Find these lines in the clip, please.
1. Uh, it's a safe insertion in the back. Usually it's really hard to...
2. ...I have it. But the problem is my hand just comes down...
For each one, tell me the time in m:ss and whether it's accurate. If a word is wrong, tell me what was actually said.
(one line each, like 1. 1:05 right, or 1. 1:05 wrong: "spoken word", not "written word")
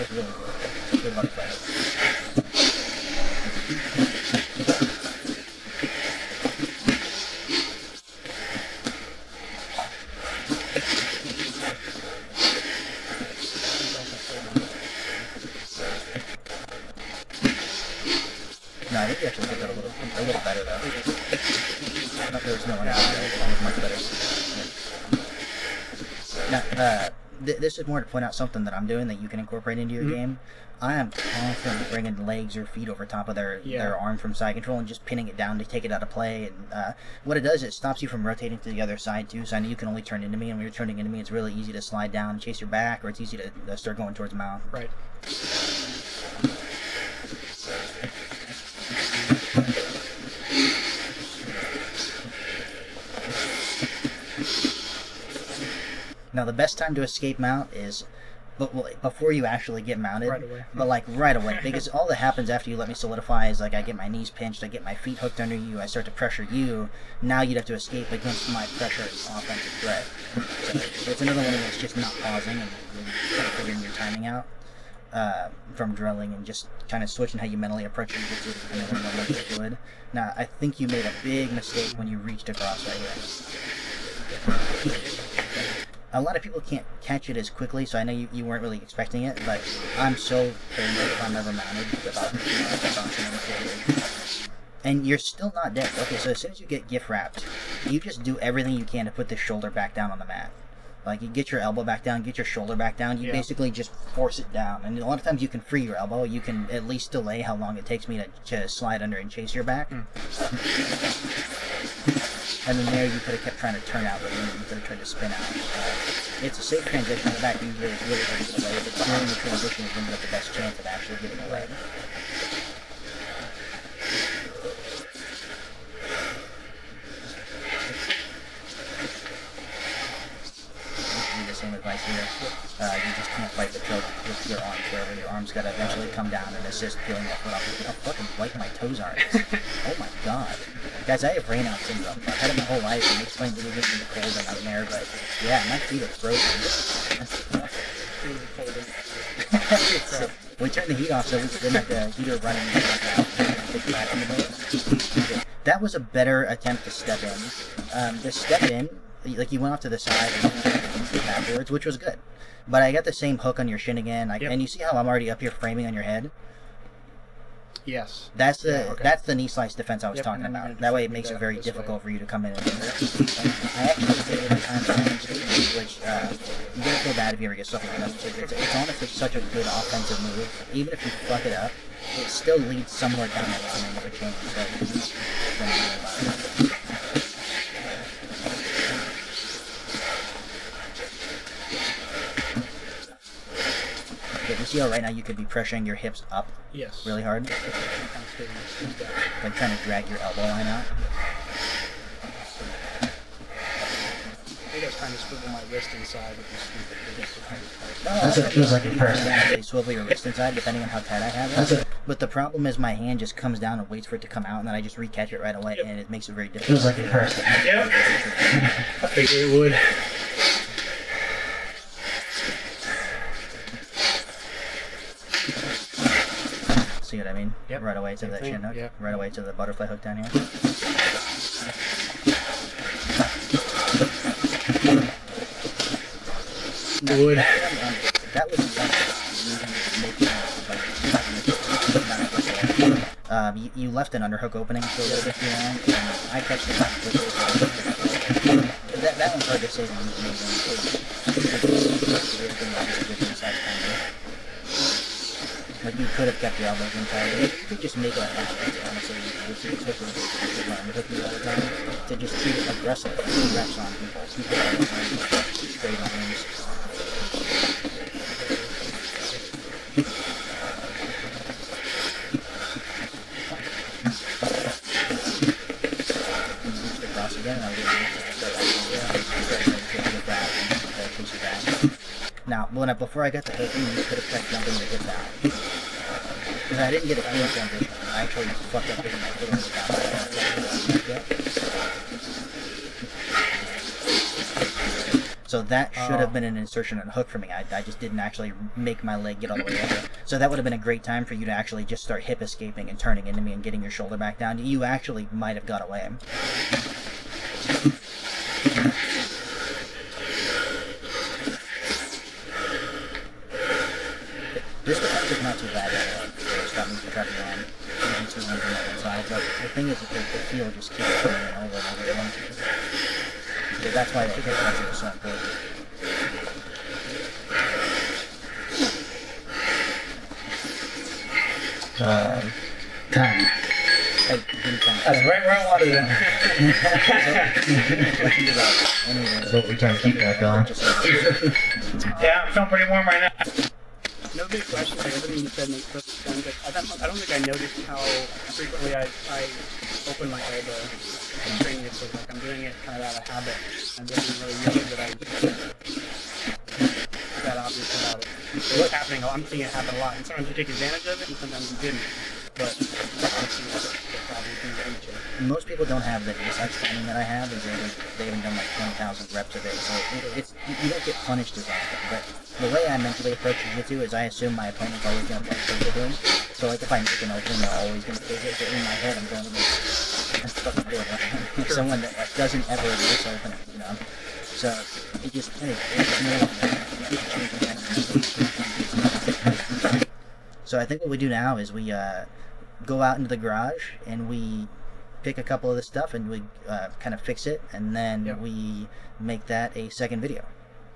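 1. 1:55 wrong: "transition", not "insertion"
2. 3:31 right.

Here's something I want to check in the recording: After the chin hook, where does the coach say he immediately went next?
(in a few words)
butterfly hook.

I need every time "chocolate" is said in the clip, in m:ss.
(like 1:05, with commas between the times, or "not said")
not said.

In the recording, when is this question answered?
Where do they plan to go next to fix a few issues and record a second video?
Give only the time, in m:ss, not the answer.
6:33.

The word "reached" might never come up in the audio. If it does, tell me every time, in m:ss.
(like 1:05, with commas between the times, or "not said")
1:22.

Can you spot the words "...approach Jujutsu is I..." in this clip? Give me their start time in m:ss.
6:13.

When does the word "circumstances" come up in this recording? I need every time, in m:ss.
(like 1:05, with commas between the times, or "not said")
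not said.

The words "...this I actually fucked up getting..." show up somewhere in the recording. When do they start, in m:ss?
4:47.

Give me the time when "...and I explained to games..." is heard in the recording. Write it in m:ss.
2:23.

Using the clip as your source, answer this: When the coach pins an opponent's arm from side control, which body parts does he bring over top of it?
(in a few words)
legs or feet.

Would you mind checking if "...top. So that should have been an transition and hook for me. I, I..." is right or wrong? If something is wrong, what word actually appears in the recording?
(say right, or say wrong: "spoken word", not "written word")
wrong: "insertion", not "transition".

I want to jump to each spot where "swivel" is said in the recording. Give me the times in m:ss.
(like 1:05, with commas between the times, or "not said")
3:25, 3:29.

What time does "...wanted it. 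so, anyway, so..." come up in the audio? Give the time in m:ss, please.
5:35.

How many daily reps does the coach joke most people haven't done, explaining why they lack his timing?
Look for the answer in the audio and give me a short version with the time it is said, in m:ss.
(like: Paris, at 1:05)
20,000, at 6:08.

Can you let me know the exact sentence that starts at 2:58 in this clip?
It's, it's honestly such a good offensive move.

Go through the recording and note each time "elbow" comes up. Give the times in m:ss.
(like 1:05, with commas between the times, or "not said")
1:41, 1:45, 3:20, 4:16, 5:50.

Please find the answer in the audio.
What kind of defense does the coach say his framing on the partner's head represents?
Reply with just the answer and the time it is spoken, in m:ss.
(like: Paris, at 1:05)
knee slice defense, at 2:49.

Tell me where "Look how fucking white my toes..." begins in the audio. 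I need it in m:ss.
2:17.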